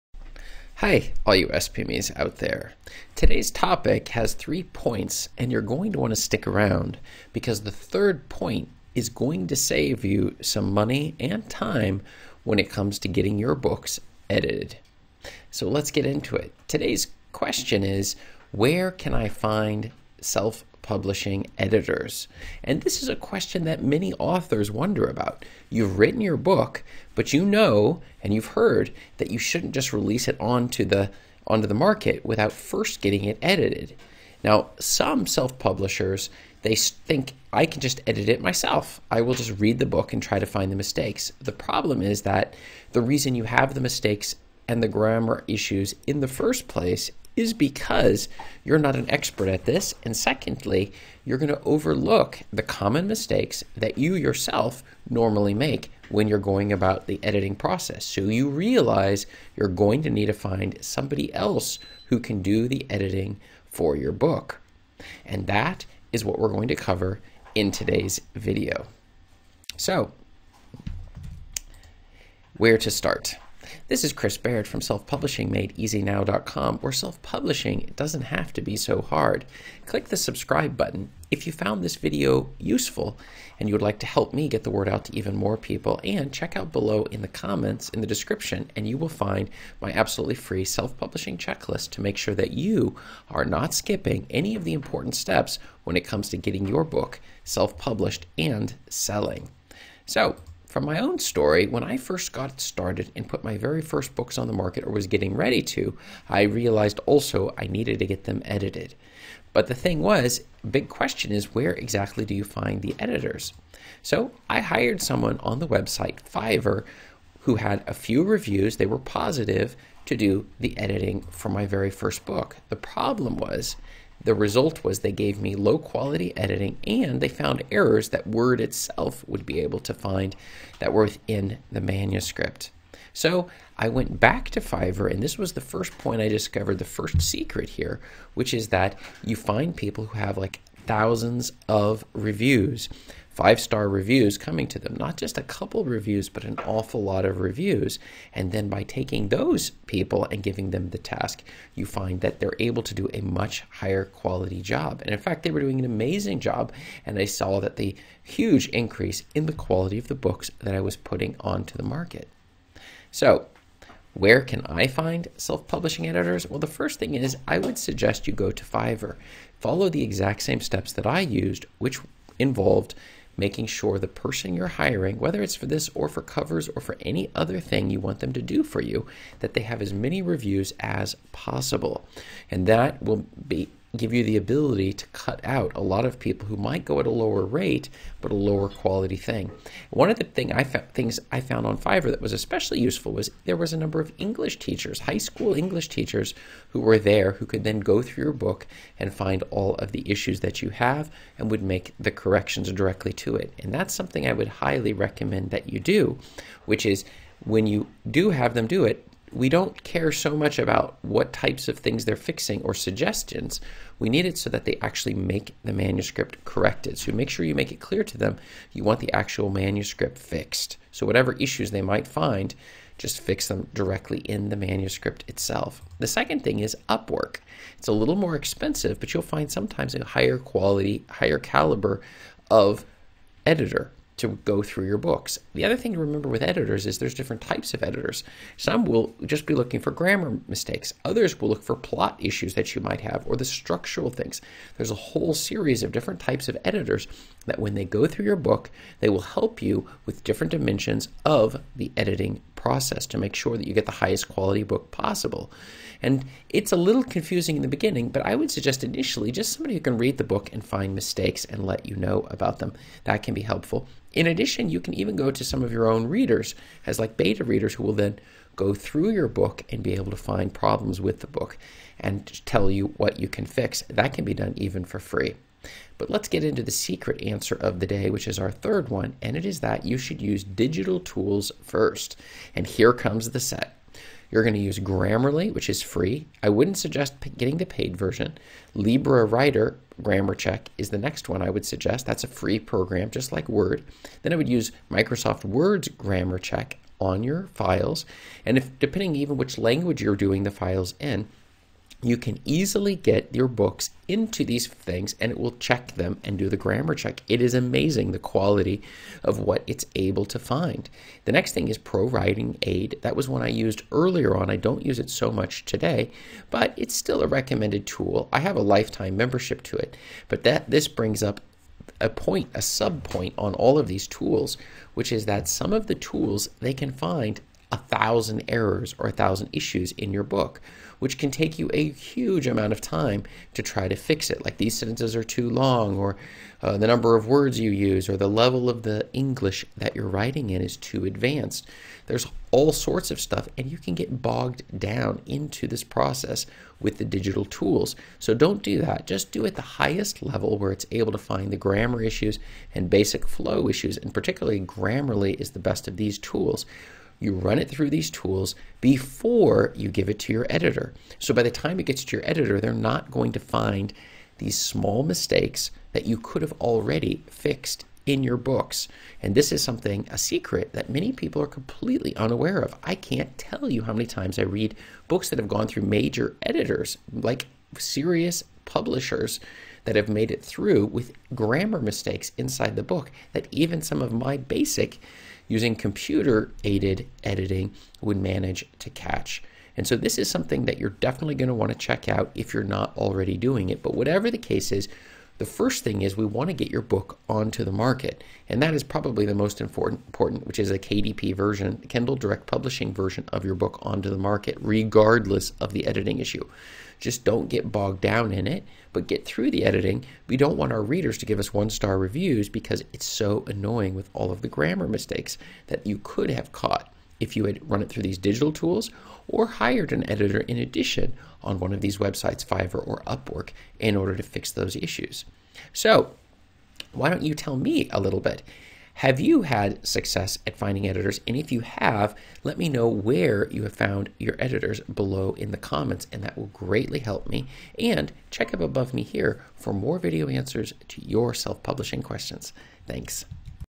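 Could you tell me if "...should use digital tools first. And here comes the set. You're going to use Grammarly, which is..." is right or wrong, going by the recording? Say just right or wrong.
right.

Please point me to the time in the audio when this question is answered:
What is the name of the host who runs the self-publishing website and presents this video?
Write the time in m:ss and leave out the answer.
1:14.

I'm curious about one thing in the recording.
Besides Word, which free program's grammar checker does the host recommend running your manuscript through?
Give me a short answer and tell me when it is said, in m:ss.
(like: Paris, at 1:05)
Libre Writer, at 4:48.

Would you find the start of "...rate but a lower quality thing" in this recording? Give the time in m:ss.
3:07.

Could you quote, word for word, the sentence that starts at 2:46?
Well, the first thing is I would suggest you go to Fiverr.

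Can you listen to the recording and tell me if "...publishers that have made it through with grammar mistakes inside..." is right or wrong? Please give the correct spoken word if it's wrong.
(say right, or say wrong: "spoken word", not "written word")
right.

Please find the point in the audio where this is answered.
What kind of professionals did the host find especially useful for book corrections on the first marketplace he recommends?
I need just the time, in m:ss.
3:15.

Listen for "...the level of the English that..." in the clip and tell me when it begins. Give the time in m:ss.
5:38.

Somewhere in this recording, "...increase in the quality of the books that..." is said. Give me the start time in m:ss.
2:38.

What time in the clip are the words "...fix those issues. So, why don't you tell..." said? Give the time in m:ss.
7:04.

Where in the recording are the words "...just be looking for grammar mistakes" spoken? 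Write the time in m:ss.
3:59.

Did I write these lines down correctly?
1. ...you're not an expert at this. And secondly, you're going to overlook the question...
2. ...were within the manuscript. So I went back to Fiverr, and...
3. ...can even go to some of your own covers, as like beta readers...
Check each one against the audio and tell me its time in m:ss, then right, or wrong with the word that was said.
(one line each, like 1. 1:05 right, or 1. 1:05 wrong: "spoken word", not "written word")
1. 0:48 wrong: "common", not "question"
2. 2:10 right
3. 4:24 wrong: "readers", not "covers".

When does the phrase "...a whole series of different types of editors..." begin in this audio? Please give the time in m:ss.
4:04.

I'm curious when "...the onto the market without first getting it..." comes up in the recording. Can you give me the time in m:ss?
0:30.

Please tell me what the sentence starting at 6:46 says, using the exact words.
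Just don't get bogged down in it, but get through the editing.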